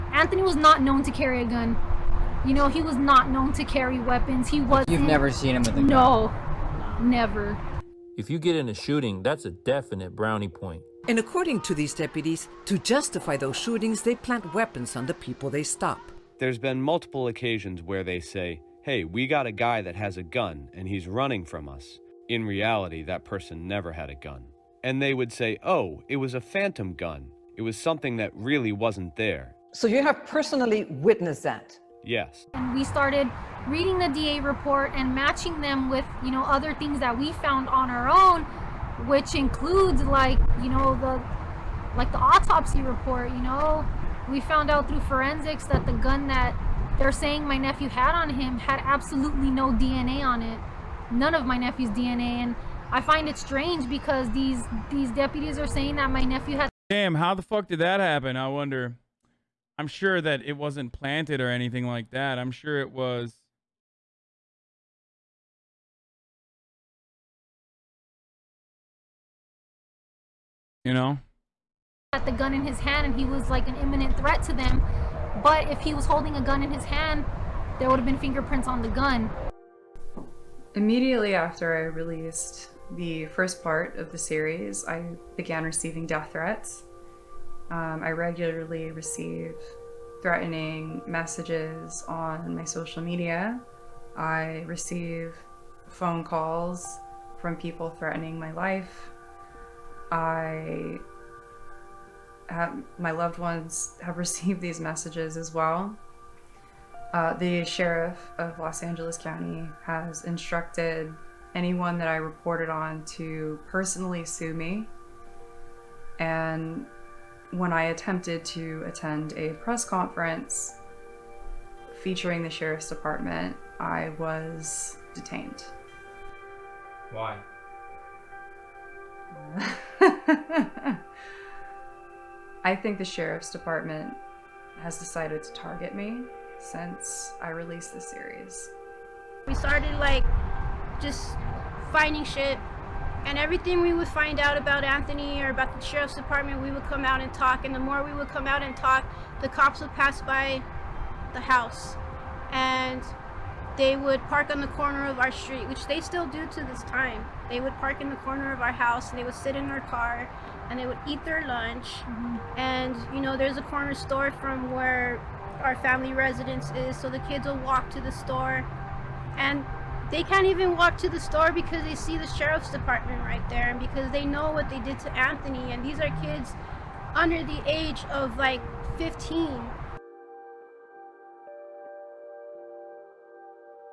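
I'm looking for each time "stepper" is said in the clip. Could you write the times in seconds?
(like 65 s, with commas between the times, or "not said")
not said.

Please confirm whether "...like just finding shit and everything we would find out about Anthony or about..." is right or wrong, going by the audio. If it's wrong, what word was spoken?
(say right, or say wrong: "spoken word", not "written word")
right.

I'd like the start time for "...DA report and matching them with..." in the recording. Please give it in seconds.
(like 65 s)
34 s.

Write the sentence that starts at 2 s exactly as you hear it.
You know, he was not known to carry weapons.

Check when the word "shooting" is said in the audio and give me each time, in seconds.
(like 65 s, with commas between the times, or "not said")
8 s, 13 s.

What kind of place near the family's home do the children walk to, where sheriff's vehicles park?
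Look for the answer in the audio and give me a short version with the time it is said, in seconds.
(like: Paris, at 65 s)
corner store, at 163 s.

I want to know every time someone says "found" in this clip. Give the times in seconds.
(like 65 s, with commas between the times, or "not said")
37 s, 44 s.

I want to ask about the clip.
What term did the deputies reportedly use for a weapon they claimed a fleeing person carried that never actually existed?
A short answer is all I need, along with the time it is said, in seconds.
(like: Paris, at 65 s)
phantom gun, at 26 s.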